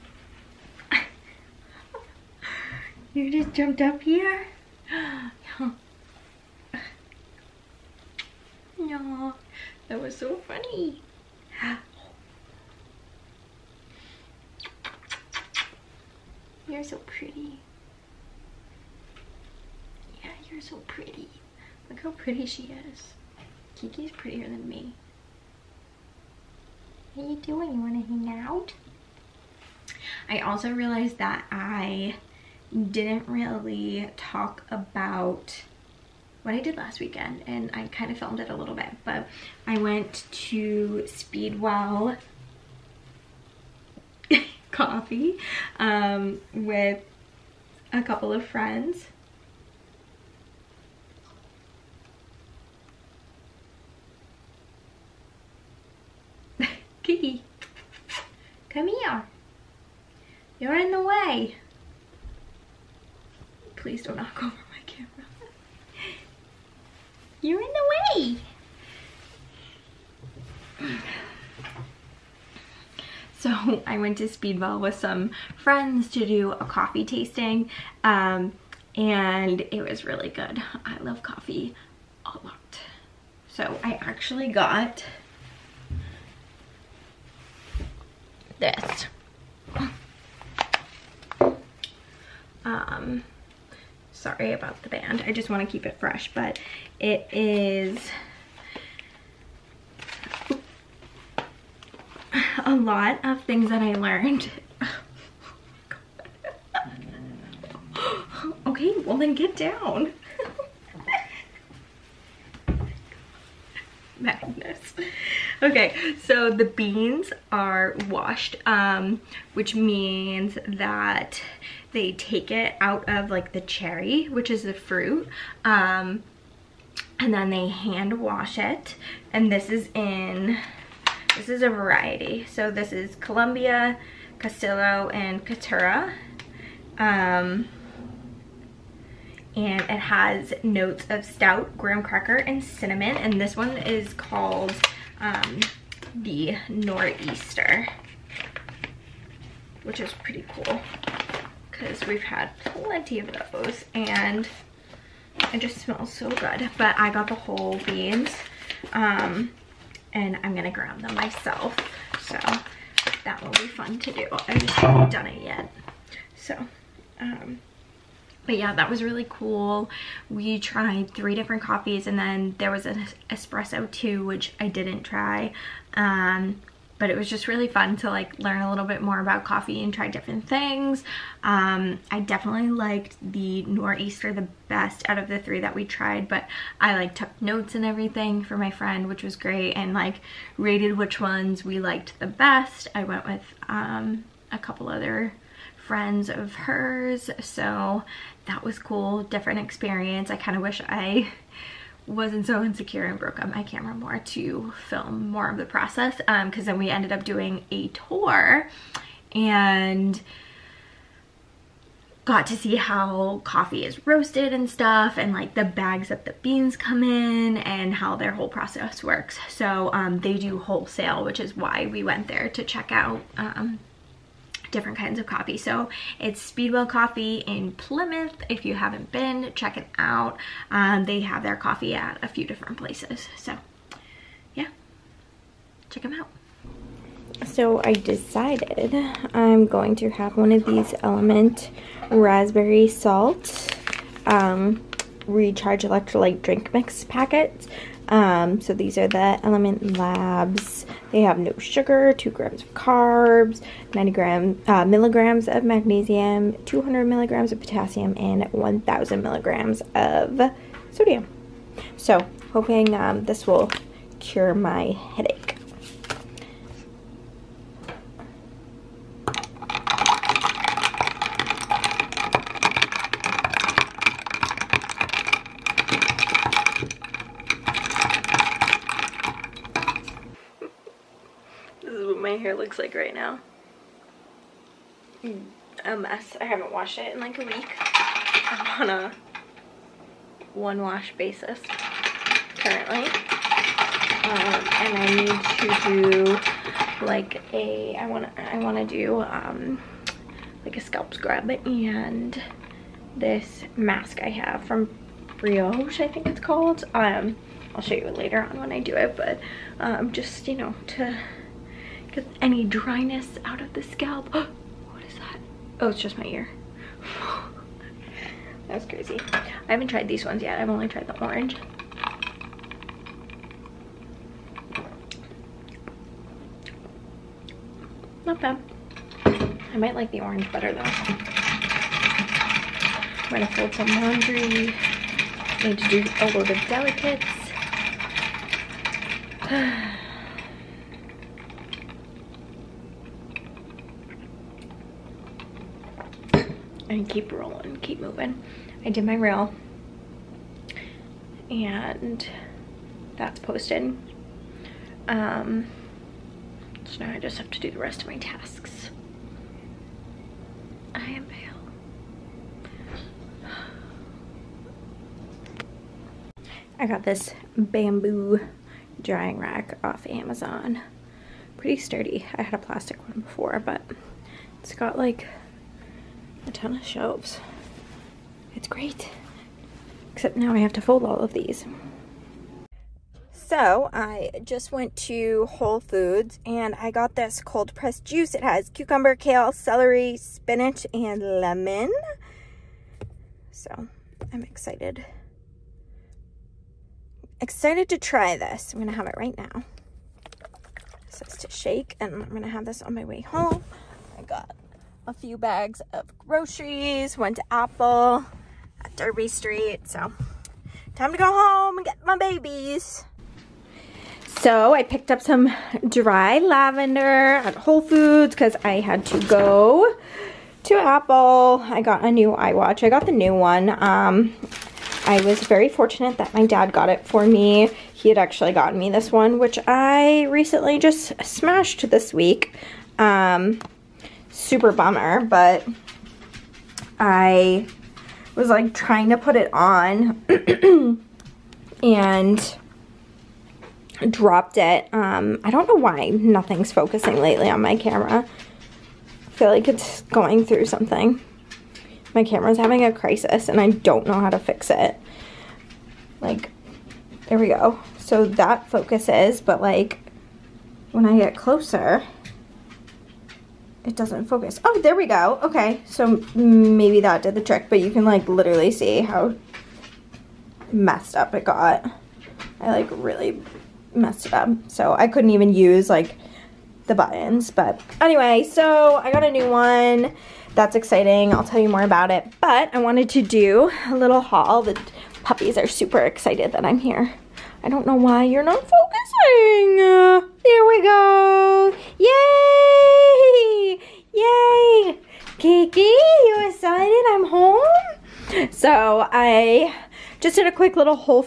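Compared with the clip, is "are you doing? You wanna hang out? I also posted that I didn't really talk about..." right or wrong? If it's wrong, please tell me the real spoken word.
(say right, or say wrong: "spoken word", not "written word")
wrong: "realized", not "posted".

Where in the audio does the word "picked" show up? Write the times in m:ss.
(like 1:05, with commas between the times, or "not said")
6:54.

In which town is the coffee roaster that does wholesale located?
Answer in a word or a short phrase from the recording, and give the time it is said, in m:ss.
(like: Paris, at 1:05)
Plymouth, at 3:47.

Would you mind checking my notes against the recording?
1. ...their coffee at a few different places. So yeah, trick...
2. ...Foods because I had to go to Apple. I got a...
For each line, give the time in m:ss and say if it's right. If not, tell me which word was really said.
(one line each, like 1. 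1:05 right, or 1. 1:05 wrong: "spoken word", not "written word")
1. 3:51 wrong: "check", not "trick"
2. 6:57 right.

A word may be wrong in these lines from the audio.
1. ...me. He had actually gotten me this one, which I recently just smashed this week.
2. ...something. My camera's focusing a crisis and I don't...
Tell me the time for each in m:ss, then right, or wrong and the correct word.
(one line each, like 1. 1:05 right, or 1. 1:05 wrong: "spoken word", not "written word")
1. 7:07 right
2. 7:30 wrong: "having", not "focusing".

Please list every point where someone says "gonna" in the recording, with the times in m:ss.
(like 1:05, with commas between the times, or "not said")
2:40, 5:33.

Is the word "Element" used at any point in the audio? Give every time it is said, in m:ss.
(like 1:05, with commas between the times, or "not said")
4:01, 4:09.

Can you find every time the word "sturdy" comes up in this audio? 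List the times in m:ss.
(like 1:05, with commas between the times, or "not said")
6:11.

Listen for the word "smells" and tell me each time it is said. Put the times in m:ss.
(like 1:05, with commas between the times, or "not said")
2:35.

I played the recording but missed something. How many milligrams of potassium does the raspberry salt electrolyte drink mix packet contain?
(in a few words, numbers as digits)
200.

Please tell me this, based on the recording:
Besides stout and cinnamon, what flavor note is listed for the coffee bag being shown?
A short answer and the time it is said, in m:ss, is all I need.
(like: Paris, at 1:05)
graham cracker, at 2:21.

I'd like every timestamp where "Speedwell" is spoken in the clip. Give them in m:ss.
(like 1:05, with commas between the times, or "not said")
0:41, 1:14, 3:46.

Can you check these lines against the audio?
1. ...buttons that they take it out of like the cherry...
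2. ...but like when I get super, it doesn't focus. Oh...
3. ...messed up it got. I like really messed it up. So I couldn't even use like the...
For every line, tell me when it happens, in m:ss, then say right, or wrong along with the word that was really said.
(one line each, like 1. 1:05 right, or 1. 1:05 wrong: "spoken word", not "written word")
1. 1:59 wrong: "means", not "buttons"
2. 7:39 wrong: "closer", not "super"
3. 7:50 right.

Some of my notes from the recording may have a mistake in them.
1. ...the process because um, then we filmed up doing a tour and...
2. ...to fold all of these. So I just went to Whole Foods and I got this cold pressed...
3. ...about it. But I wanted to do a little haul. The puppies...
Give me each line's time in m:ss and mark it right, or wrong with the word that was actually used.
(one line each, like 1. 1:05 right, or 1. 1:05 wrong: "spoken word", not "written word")
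1. 3:25 wrong: "ended", not "filmed"
2. 6:20 right
3. 8:01 right.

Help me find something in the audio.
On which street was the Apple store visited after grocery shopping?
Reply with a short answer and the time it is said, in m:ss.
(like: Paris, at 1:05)
Derby Street, at 6:48.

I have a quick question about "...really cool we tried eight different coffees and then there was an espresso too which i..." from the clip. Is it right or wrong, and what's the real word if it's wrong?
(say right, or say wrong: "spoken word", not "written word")
wrong: "three", not "eight".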